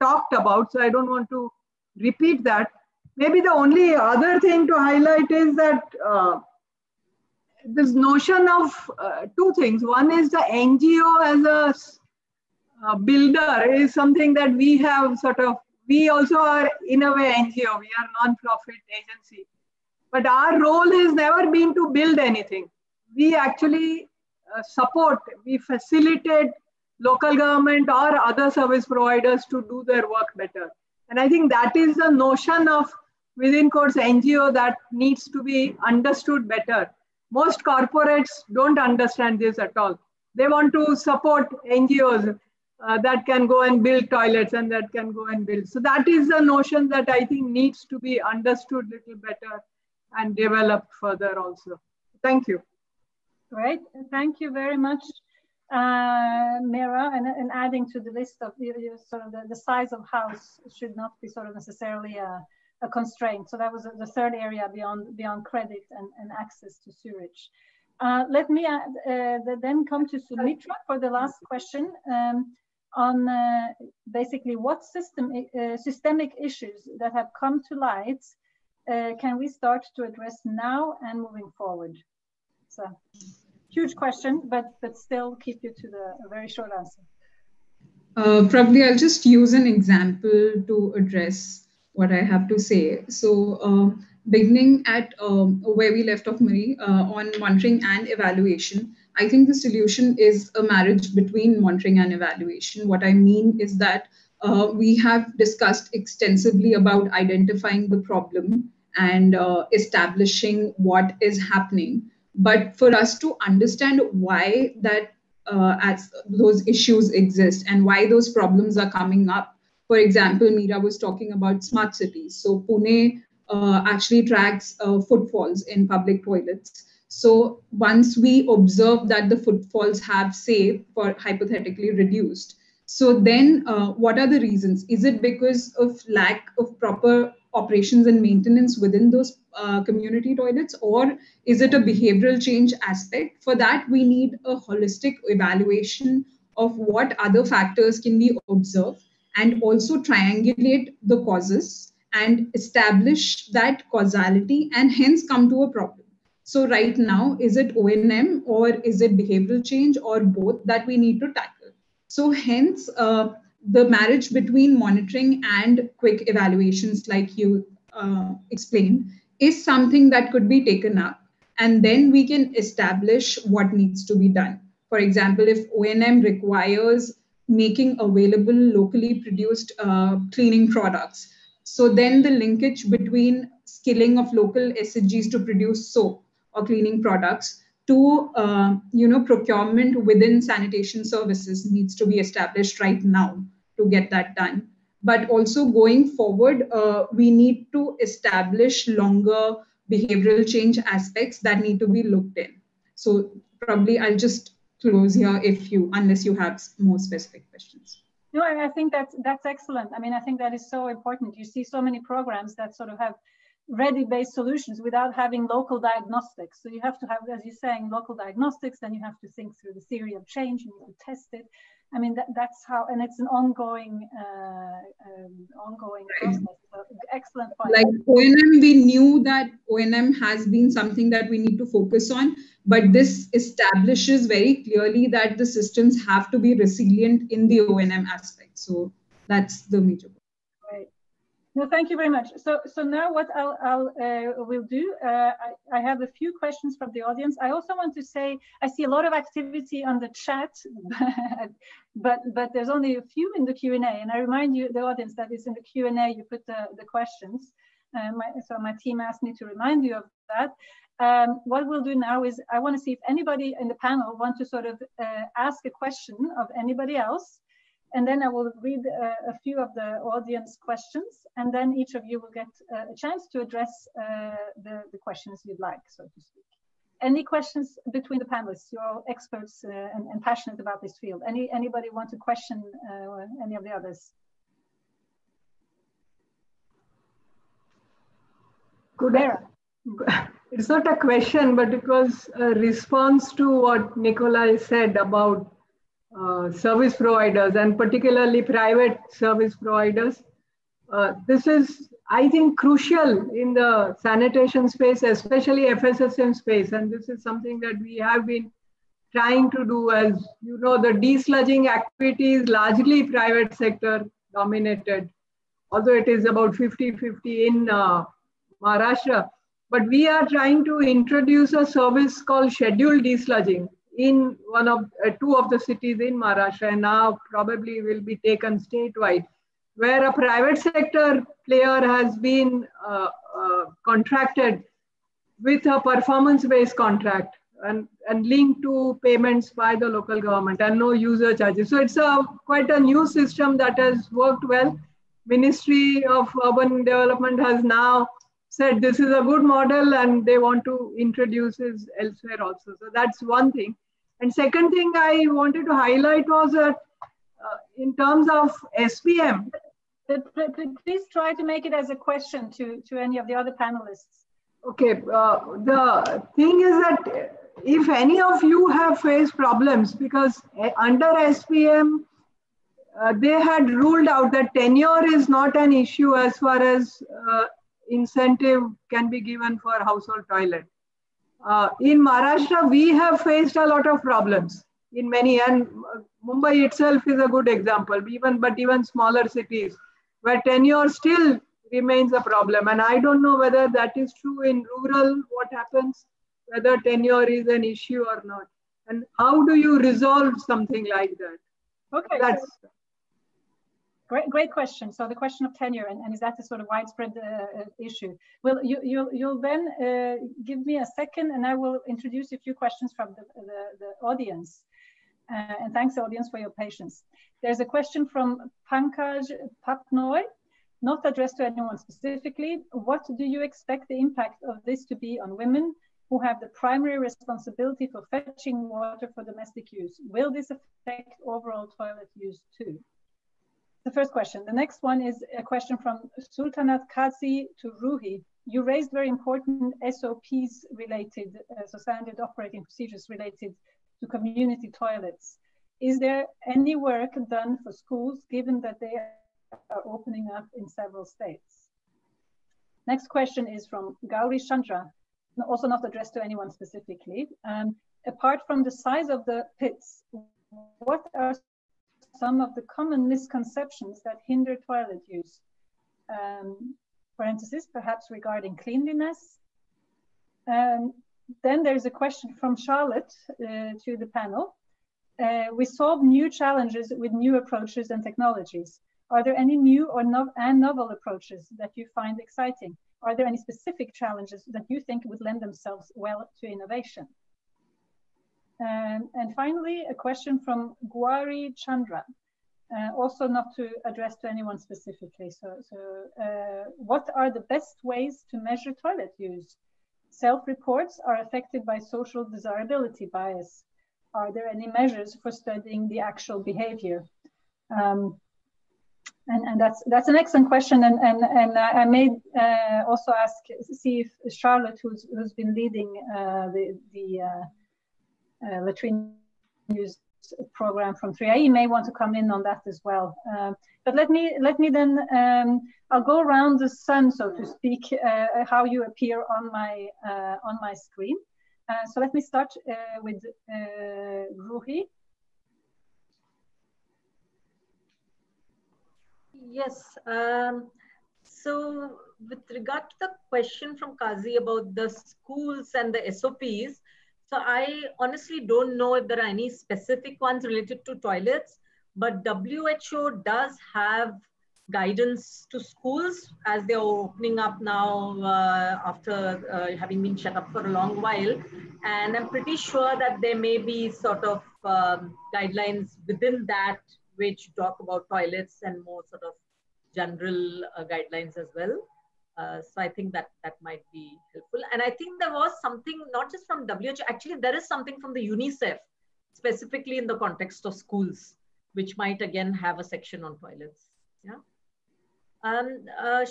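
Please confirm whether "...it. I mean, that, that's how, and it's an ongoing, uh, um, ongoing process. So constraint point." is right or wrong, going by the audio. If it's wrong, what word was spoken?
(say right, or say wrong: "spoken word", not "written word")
wrong: "excellent", not "constraint".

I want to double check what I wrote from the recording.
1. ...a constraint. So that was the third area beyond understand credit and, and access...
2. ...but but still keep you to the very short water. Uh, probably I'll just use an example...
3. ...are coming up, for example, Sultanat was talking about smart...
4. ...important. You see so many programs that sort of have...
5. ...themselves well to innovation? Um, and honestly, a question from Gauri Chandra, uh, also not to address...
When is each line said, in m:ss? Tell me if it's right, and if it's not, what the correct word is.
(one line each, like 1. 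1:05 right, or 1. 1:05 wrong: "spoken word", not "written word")
1. 1:02 wrong: "beyond", not "understand"
2. 1:24 wrong: "answer", not "water"
3. 1:58 wrong: "Meera", not "Sultanat"
4. 3:30 right
5. 8:05 wrong: "finally", not "honestly".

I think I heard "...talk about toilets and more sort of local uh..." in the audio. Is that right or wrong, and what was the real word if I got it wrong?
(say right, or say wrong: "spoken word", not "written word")
wrong: "general", not "local".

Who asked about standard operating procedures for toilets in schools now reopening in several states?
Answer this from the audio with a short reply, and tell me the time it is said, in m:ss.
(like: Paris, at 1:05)
Sultanat Kazi, at 7:16.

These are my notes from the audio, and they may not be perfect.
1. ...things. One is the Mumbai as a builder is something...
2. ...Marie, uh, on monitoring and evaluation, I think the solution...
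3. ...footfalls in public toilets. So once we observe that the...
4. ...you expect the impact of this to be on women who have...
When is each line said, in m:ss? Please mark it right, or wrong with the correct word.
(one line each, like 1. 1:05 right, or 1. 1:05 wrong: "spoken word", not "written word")
1. 0:09 wrong: "NGO", not "Mumbai"
2. 1:36 right
3. 2:05 right
4. 7:03 right.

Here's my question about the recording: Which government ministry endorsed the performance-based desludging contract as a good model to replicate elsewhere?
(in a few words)
Ministry of Urban Development.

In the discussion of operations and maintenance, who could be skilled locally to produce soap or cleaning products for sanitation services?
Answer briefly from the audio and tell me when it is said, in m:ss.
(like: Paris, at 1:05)
Local SGS, at 3:04.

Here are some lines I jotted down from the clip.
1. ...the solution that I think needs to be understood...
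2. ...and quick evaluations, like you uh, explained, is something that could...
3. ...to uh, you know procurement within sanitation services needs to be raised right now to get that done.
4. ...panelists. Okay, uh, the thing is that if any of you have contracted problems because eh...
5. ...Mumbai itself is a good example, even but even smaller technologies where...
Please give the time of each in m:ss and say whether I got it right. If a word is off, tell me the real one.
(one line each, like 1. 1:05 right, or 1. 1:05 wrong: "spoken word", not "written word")
1. 0:46 wrong: "notion", not "solution"
2. 2:45 right
3. 3:07 wrong: "established", not "raised"
4. 6:03 wrong: "faced", not "contracted"
5. 6:26 wrong: "cities", not "technologies".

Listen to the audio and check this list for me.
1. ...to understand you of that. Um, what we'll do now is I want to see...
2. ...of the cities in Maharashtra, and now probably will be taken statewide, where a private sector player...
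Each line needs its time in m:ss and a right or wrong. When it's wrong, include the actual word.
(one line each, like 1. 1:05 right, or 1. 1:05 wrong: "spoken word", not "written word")
1. 4:19 wrong: "remind", not "understand"
2. 5:25 right.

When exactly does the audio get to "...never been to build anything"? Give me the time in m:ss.
0:21.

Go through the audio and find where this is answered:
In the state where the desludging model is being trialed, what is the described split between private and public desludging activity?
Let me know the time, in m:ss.
5:16.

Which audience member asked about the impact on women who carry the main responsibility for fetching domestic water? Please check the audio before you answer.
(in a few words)
Pankaj Patnoy.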